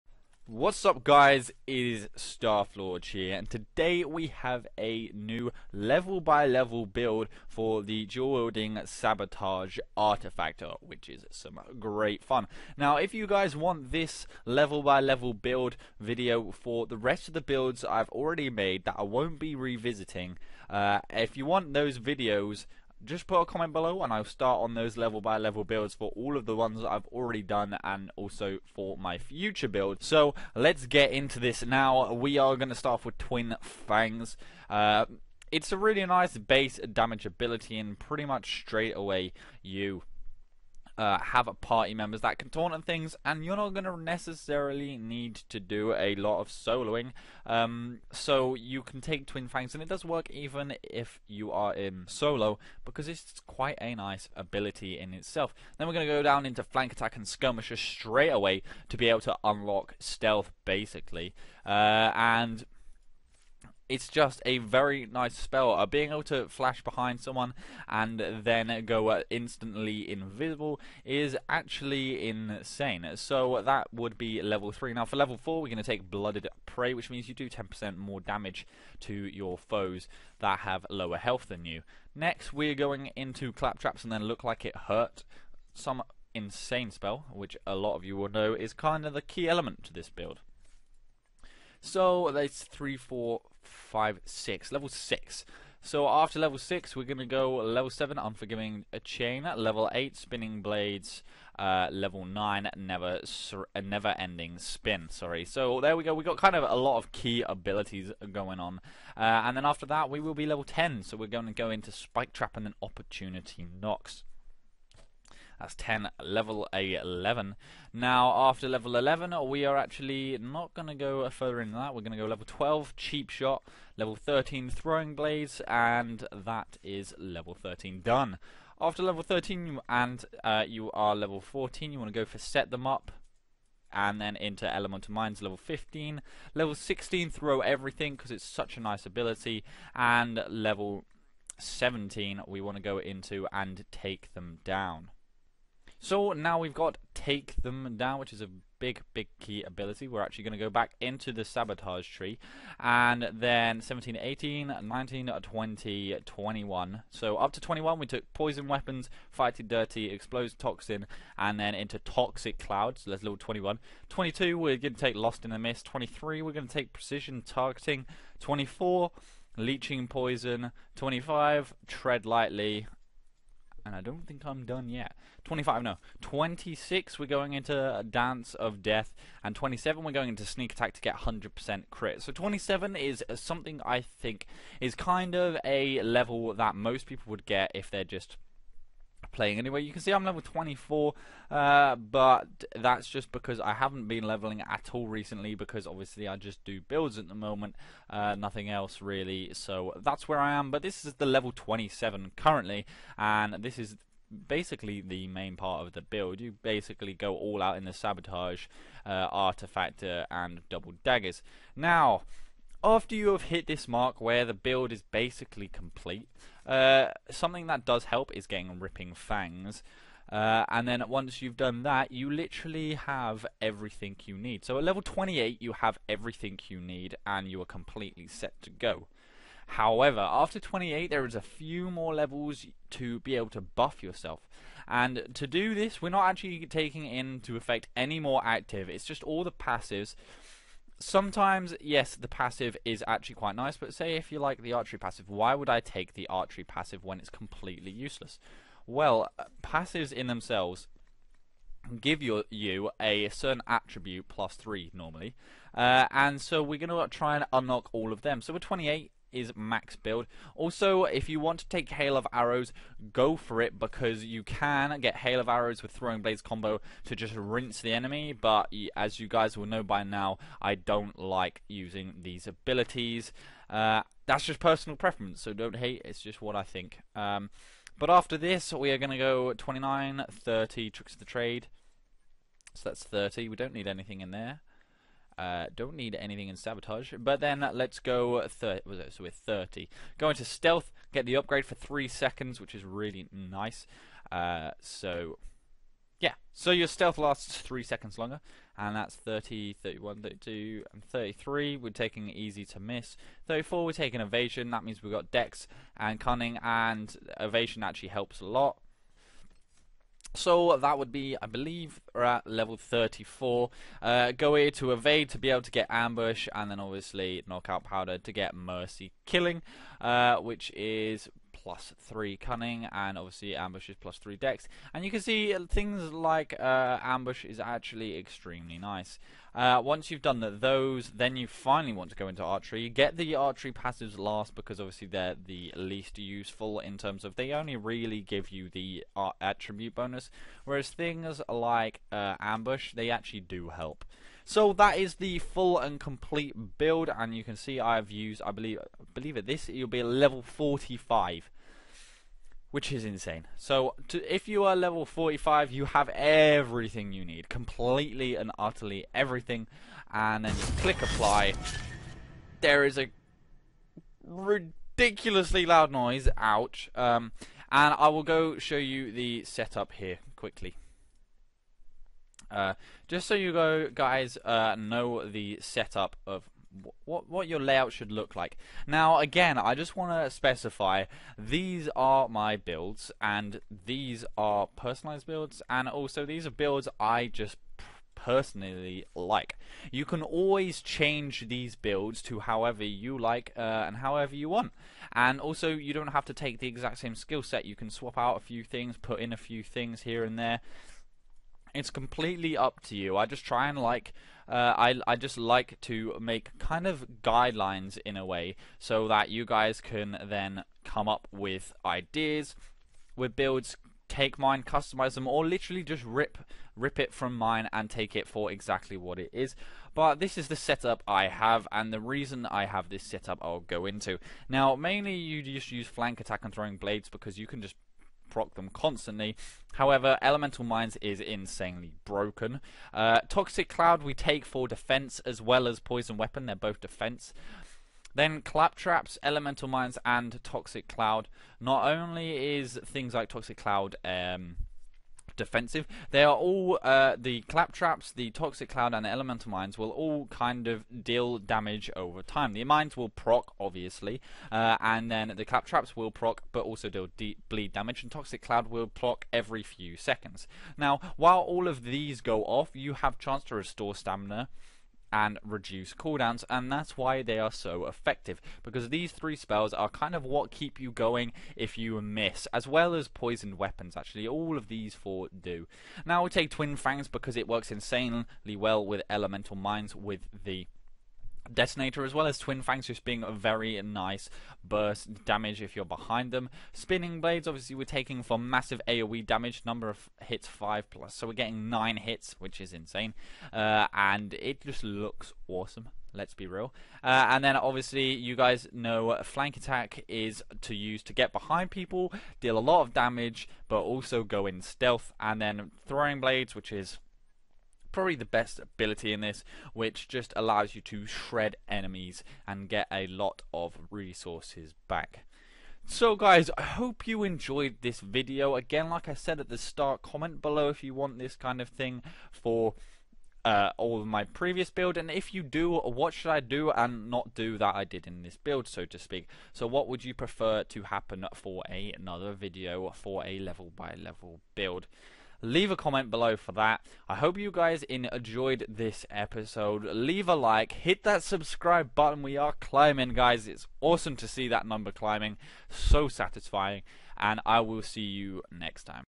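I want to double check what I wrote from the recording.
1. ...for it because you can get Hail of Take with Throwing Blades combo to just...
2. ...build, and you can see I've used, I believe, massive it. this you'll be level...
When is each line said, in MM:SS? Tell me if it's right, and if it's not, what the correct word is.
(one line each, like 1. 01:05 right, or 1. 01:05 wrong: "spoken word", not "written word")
1. 04:23 wrong: "Arrows", not "Take"
2. 05:46 wrong: "believe", not "massive".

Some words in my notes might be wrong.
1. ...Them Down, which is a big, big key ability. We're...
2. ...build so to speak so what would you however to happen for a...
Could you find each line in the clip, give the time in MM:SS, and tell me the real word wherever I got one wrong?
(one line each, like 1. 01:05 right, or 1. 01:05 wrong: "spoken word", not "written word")
1. 02:27 right
2. 08:48 wrong: "prefer", not "however".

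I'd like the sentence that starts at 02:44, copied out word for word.
22 we're going to take Lost in the Mist.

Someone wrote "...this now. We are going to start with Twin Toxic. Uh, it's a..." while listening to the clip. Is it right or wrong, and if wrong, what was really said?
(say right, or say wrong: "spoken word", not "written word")
wrong: "Fangs", not "Toxic".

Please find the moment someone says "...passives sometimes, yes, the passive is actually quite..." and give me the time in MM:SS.
03:59.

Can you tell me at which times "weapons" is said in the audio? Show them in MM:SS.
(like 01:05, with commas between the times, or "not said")
02:38, 07:16, 07:53.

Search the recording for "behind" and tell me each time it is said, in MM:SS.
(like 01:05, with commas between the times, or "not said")
01:06, 08:05, 08:21.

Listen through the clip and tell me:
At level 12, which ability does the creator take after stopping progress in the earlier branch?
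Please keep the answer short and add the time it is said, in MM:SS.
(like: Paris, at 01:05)
Cheap Shot, at 02:02.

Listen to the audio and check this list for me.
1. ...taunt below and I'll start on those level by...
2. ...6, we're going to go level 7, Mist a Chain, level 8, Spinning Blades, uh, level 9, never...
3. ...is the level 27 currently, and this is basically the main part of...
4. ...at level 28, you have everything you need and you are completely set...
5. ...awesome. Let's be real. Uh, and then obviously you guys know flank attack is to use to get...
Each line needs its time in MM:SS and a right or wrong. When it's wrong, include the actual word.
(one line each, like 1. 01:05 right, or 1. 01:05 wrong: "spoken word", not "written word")
1. 00:23 wrong: "comment", not "taunt"
2. 01:36 wrong: "Unforgiving", not "Mist"
3. 03:21 right
4. 03:44 right
5. 08:15 right.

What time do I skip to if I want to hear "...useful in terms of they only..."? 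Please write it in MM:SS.
05:36.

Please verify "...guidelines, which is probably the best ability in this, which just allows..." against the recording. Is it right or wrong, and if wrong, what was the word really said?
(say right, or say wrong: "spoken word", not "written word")
wrong: "blades", not "guidelines".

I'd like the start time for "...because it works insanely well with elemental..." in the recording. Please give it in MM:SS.
07:57.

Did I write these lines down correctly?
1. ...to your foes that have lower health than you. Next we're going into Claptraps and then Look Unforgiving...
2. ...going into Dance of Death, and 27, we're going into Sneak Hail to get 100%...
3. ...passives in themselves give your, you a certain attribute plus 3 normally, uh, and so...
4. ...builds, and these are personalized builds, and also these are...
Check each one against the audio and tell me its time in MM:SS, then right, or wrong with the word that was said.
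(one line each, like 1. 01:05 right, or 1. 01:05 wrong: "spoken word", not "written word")
1. 01:19 wrong: "Like", not "Unforgiving"
2. 02:57 wrong: "Attack", not "Hail"
3. 04:09 right
4. 06:22 right.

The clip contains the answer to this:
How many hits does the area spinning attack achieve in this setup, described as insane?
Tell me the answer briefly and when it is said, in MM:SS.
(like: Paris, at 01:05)
9, at 08:11.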